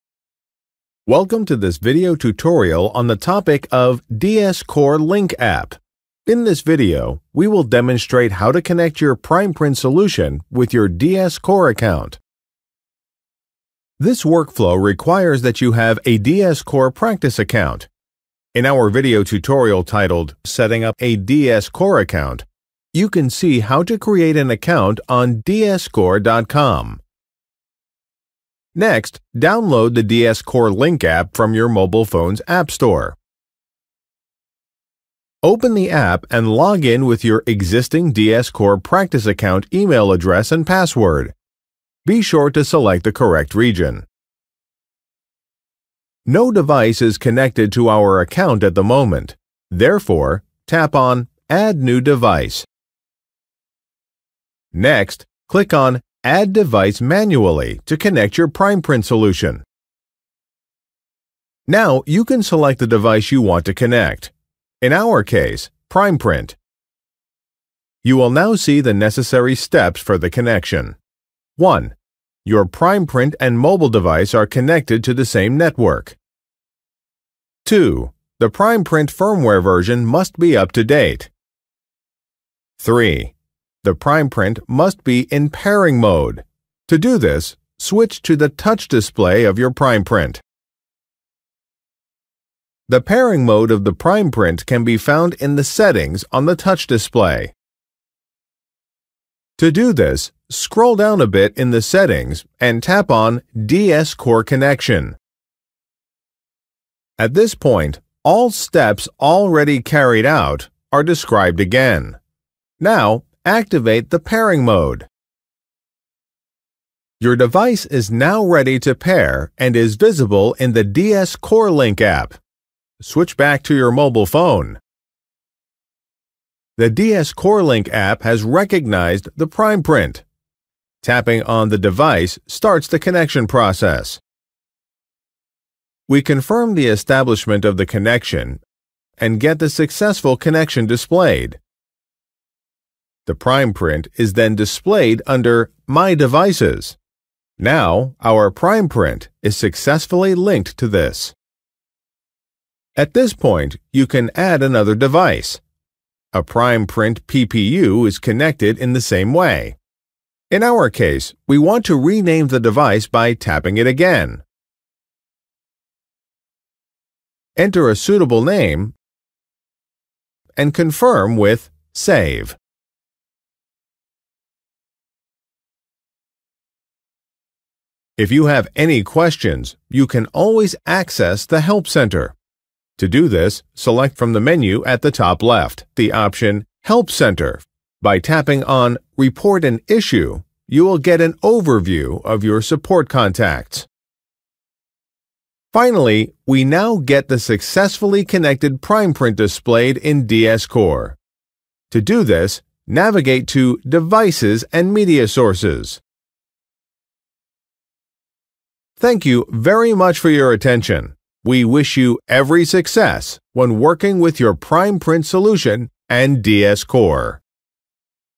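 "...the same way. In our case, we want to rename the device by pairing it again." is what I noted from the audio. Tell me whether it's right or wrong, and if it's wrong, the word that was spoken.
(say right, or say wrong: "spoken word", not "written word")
wrong: "tapping", not "pairing".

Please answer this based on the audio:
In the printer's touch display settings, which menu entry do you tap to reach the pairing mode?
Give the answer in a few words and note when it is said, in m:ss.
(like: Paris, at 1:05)
DS Core Connection, at 1:43.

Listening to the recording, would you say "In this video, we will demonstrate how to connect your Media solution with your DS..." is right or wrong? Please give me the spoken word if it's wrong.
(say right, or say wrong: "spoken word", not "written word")
wrong: "PrimePrint", not "Media".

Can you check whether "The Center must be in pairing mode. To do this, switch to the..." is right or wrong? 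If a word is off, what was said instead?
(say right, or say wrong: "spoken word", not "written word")
wrong: "Primeprint", not "Center".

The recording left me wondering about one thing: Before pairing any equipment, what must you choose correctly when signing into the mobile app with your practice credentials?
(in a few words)
Region.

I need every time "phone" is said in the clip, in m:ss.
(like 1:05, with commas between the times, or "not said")
0:32, 2:04.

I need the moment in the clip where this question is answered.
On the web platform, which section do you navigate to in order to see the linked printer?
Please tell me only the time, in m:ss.
3:23.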